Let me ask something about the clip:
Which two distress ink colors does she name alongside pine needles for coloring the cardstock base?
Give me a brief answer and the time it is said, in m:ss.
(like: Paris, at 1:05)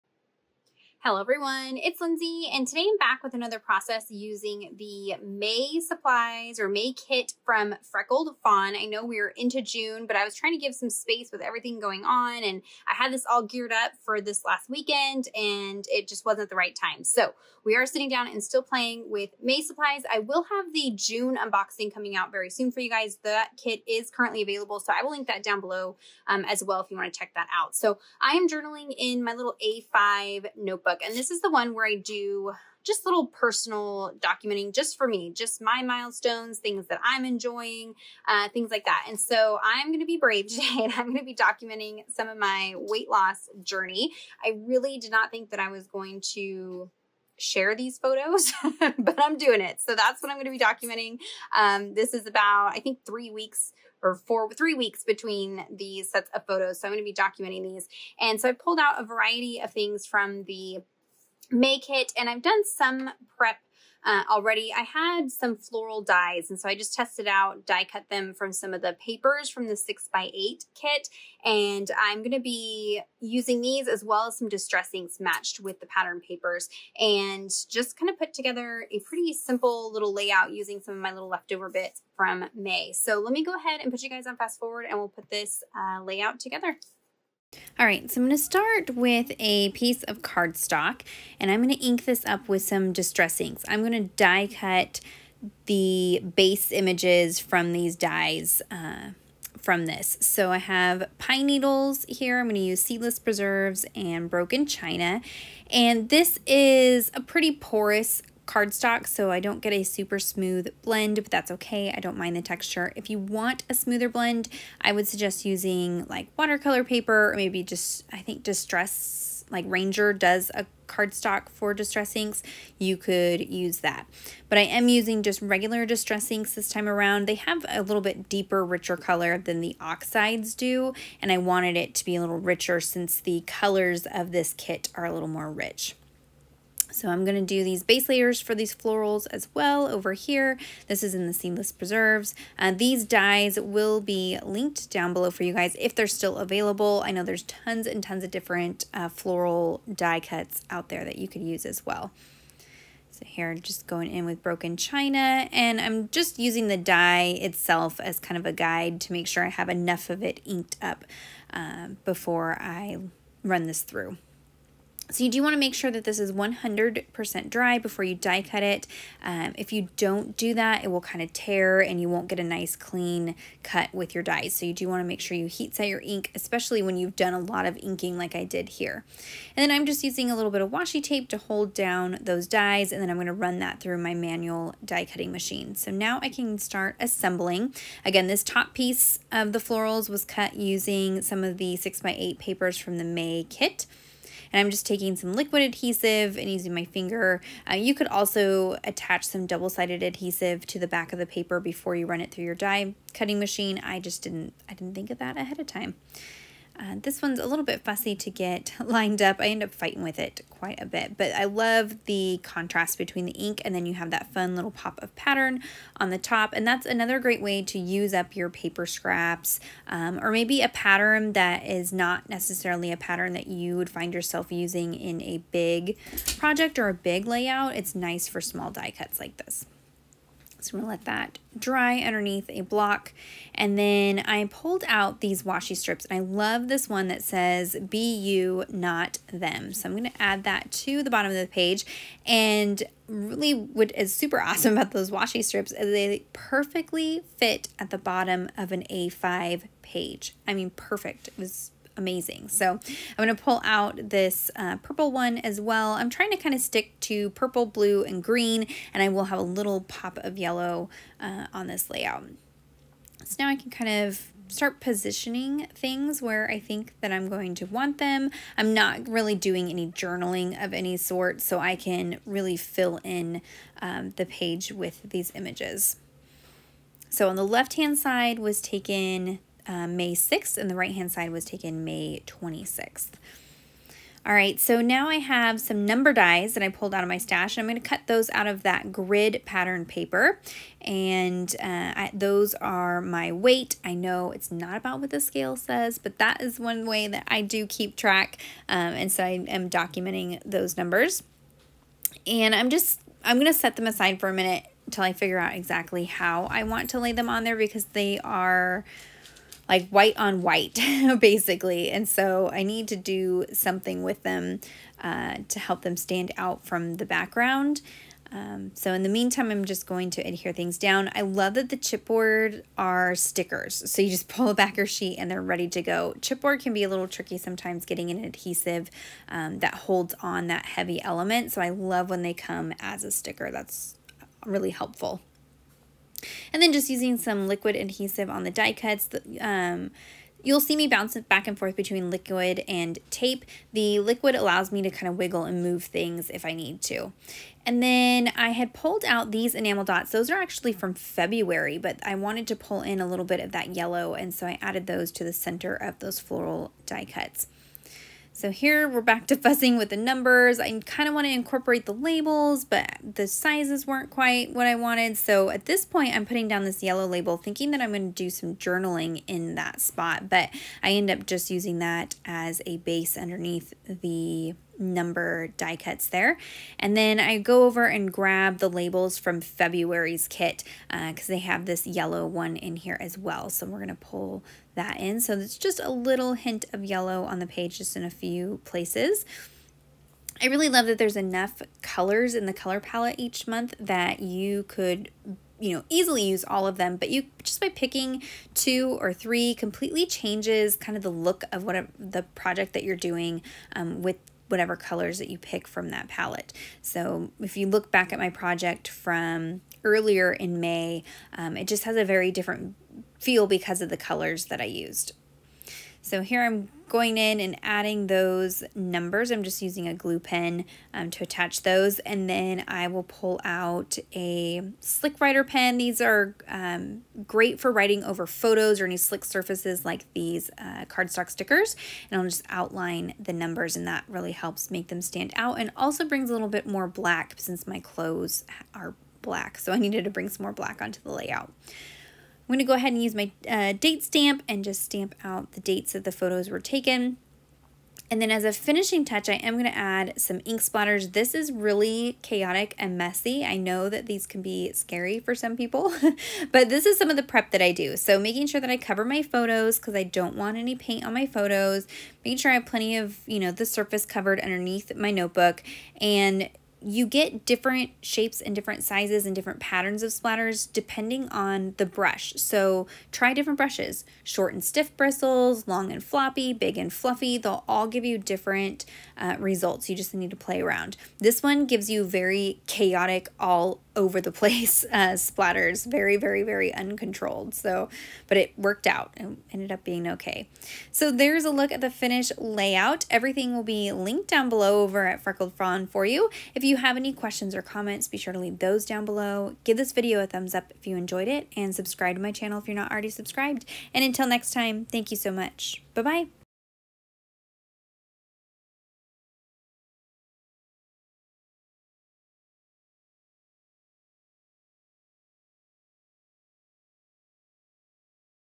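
seedless preserves and broken china, at 1:42.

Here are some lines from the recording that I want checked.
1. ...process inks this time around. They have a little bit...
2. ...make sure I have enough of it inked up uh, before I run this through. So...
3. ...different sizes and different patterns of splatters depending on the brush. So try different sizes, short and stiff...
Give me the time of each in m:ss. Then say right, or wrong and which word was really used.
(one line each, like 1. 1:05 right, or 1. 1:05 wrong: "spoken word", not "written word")
1. 2:05 wrong: "distress", not "process"
2. 2:39 right
3. 7:48 wrong: "brushes", not "sizes".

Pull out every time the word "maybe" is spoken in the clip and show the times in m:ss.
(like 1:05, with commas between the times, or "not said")
1:57, 3:40.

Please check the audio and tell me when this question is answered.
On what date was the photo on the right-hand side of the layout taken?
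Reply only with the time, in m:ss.
4:41.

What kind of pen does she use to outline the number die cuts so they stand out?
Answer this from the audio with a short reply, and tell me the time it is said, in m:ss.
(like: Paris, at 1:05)
slick writer pen, at 7:04.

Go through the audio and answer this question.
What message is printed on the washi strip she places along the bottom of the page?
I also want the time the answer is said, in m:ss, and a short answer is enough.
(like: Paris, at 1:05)
be you, not them, at 3:57.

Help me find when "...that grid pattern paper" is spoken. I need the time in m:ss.
4:48.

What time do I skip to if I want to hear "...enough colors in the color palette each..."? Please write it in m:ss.
6:31.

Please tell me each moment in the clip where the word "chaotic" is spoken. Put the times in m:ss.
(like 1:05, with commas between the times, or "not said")
7:32, 8:02.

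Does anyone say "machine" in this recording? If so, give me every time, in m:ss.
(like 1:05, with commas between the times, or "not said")
3:05, 3:23.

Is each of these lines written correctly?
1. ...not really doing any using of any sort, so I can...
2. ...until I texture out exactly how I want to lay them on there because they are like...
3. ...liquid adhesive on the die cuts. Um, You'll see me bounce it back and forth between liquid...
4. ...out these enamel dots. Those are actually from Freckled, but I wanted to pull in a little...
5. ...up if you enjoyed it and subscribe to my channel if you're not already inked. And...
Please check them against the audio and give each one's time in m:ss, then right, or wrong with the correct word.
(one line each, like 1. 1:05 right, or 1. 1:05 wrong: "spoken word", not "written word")
1. 4:28 wrong: "journaling", not "using"
2. 5:04 wrong: "figure", not "texture"
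3. 5:37 right
4. 5:49 wrong: "February", not "Freckled"
5. 8:20 wrong: "subscribed", not "inked".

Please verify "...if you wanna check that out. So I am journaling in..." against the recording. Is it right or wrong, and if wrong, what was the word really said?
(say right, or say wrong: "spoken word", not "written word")
right.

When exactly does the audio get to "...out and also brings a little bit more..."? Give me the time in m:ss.
7:15.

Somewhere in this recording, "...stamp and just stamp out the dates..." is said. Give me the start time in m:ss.
7:24.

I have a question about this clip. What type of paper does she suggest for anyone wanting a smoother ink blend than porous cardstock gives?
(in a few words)
watercolor paper.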